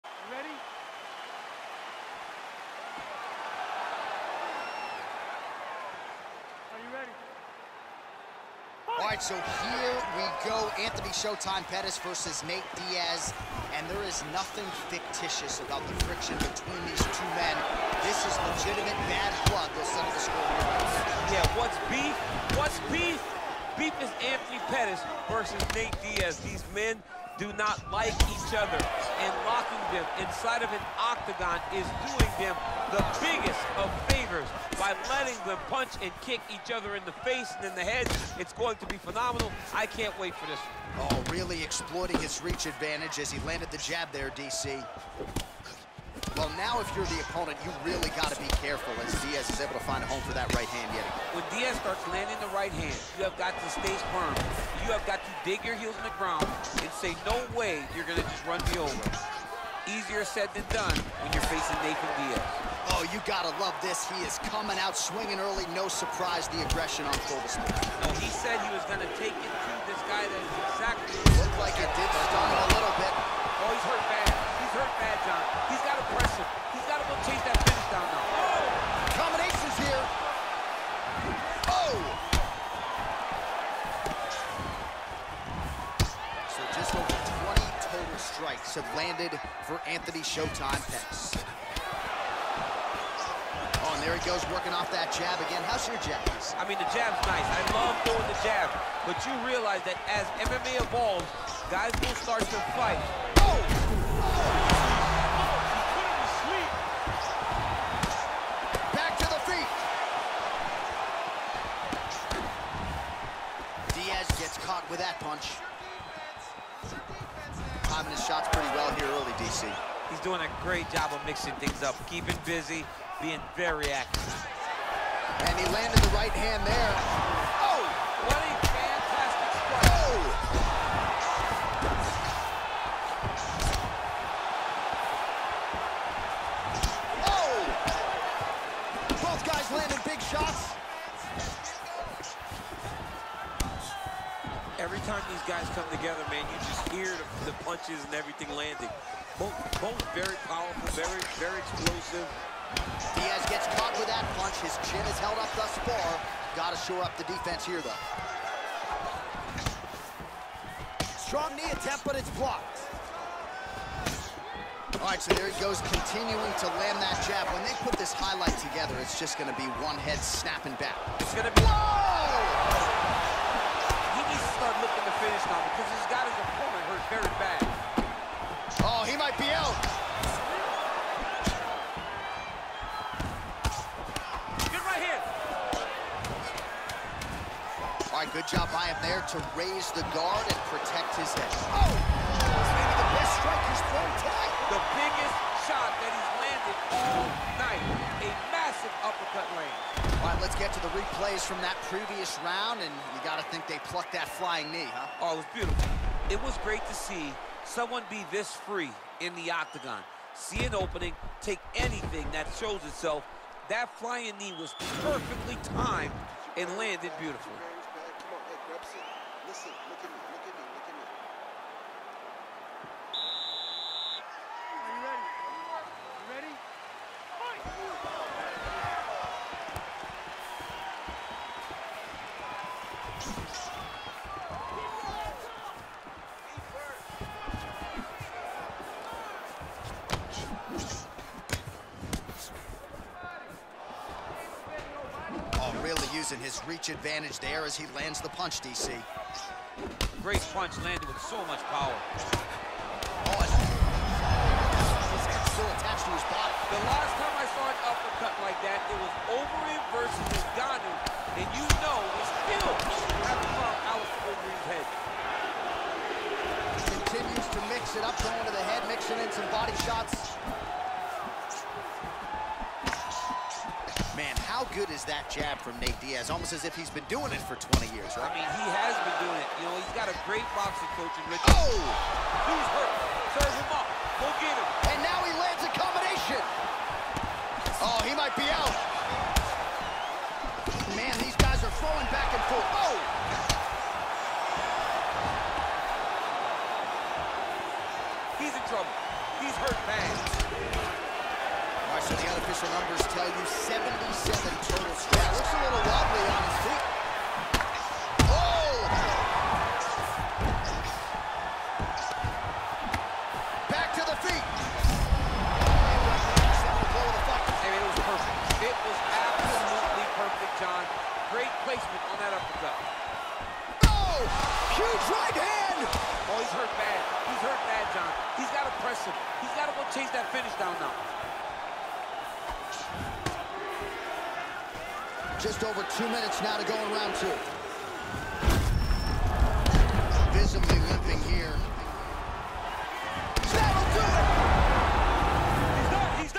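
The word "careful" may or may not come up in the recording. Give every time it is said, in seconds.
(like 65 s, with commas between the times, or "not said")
48 s.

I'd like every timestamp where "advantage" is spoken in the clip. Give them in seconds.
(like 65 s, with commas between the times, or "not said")
42 s, 246 s.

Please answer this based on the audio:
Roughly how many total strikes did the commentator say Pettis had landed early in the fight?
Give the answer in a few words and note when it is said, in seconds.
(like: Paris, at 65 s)
Over 20, at 86 s.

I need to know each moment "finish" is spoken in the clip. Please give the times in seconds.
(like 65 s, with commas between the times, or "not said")
77 s, 330 s.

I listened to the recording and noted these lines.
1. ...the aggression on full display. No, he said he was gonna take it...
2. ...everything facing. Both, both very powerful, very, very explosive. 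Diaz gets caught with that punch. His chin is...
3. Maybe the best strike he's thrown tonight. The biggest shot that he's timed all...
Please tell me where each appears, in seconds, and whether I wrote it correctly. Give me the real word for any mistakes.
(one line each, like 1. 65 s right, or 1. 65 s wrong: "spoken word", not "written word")
1. 66 s right
2. 148 s wrong: "landing", not "facing"
3. 191 s wrong: "landed", not "timed".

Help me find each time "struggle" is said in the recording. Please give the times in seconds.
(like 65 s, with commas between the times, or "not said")
not said.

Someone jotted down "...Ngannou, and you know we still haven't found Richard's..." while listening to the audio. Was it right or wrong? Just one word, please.
wrong.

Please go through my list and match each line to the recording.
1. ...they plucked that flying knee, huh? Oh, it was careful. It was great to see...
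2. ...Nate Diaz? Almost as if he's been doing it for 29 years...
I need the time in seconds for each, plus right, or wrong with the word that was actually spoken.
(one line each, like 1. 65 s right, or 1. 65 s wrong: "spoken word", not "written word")
1. 203 s wrong: "beautiful", not "careful"
2. 275 s wrong: "20", not "29".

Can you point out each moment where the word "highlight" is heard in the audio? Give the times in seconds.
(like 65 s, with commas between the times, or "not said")
168 s.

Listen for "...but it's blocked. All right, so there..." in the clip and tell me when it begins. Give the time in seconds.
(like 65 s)
162 s.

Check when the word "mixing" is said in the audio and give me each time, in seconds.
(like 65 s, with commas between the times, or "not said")
121 s, 268 s.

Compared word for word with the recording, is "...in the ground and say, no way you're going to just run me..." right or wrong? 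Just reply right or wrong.
right.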